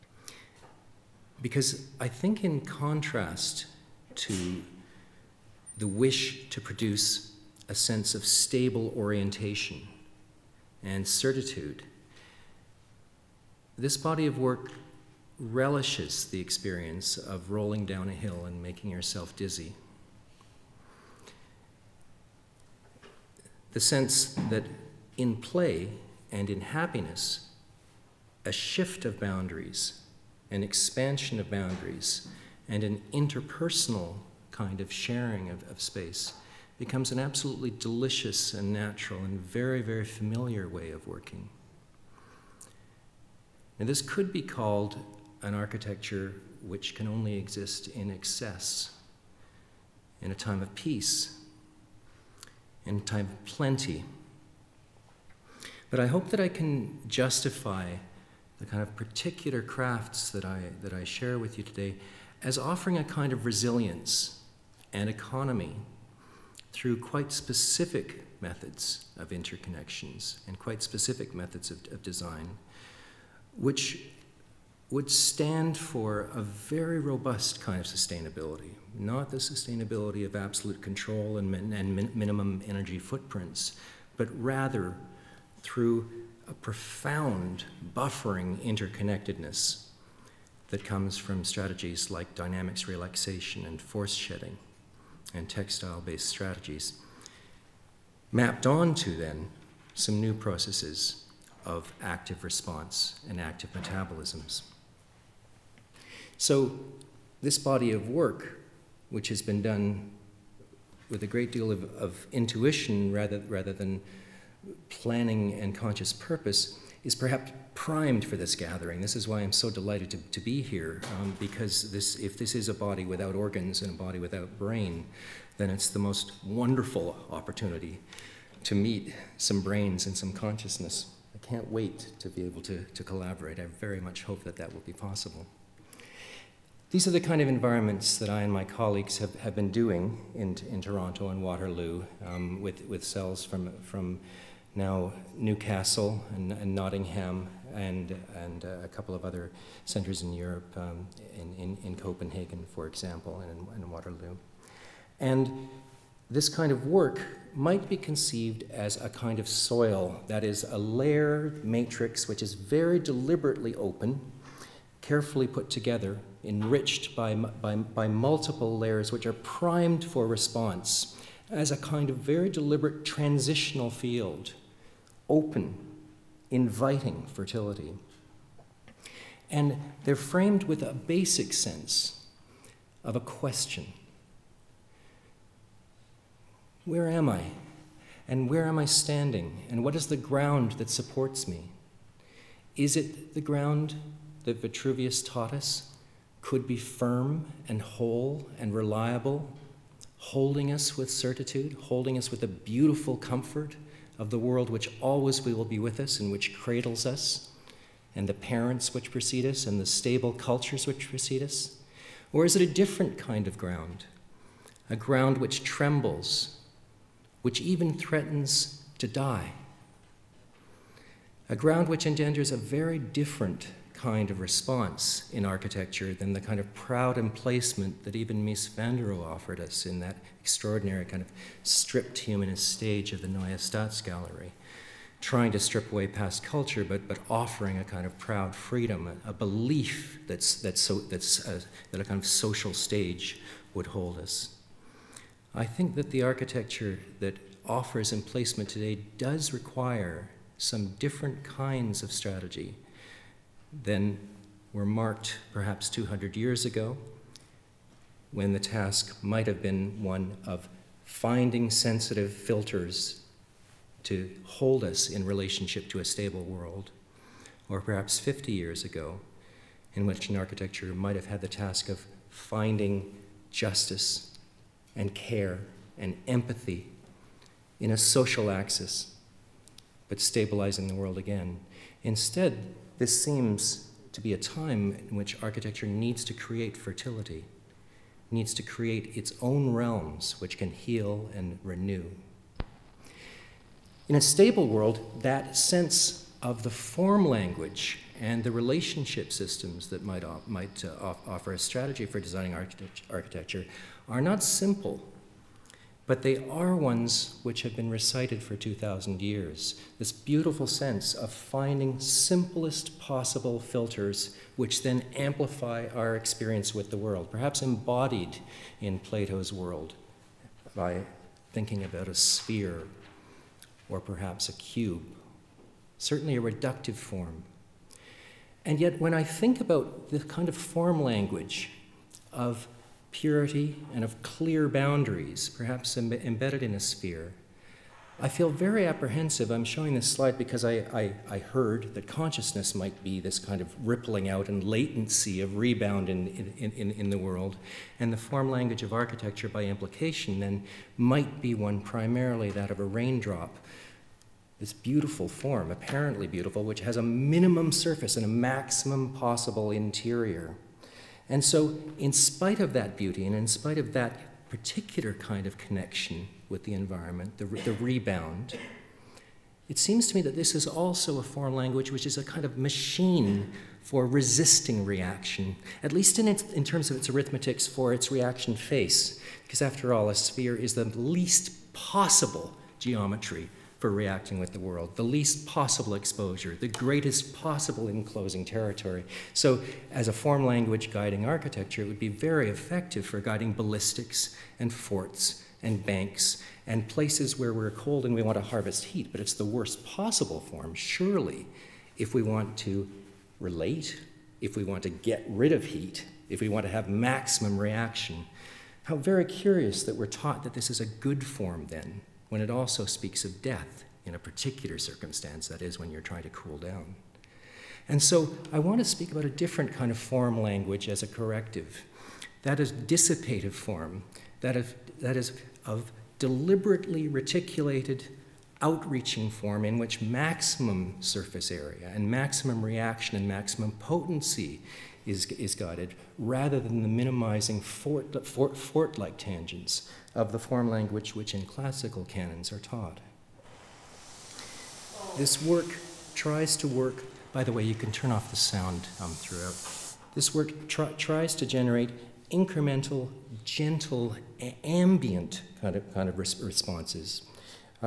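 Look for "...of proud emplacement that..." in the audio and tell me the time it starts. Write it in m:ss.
3:46.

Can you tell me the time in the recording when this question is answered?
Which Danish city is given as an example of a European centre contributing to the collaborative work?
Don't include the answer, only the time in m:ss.
2:31.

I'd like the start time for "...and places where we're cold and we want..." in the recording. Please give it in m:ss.
6:36.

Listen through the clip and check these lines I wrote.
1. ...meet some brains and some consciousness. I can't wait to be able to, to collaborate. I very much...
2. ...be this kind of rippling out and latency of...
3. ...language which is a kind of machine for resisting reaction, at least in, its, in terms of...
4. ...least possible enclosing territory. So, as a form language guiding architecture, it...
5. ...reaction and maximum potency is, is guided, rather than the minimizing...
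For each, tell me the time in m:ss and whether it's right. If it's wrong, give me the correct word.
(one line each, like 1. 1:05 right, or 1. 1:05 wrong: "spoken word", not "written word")
1. 2:08 right
2. 5:43 right
3. 6:11 right
4. 6:26 wrong: "greatest", not "least"
5. 7:12 right.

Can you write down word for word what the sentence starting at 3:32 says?
Or is it a different kind of ground?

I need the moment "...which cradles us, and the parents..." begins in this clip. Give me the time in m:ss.
3:26.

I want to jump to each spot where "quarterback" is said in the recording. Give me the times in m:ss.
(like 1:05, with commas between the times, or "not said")
not said.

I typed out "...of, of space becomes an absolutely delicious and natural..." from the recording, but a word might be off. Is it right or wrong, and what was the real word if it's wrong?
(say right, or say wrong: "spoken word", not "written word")
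right.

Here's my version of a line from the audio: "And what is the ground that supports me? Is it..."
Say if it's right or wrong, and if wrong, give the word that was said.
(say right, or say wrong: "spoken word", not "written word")
right.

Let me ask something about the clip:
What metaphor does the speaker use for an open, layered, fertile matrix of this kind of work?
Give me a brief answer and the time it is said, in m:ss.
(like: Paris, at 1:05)
soil, at 2:39.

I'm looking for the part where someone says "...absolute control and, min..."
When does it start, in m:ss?
1:20.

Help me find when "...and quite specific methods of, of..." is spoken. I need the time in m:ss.
1:10.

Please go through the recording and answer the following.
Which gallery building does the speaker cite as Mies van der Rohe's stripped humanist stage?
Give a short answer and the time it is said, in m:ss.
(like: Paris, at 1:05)
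Neue Staatsgalerie, at 3:53.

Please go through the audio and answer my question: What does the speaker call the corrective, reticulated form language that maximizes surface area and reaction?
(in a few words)
dissipative form.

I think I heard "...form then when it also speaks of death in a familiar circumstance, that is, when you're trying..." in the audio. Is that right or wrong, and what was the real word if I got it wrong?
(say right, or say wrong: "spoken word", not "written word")
wrong: "particular", not "familiar".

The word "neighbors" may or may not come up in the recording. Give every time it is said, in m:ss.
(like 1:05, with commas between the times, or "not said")
not said.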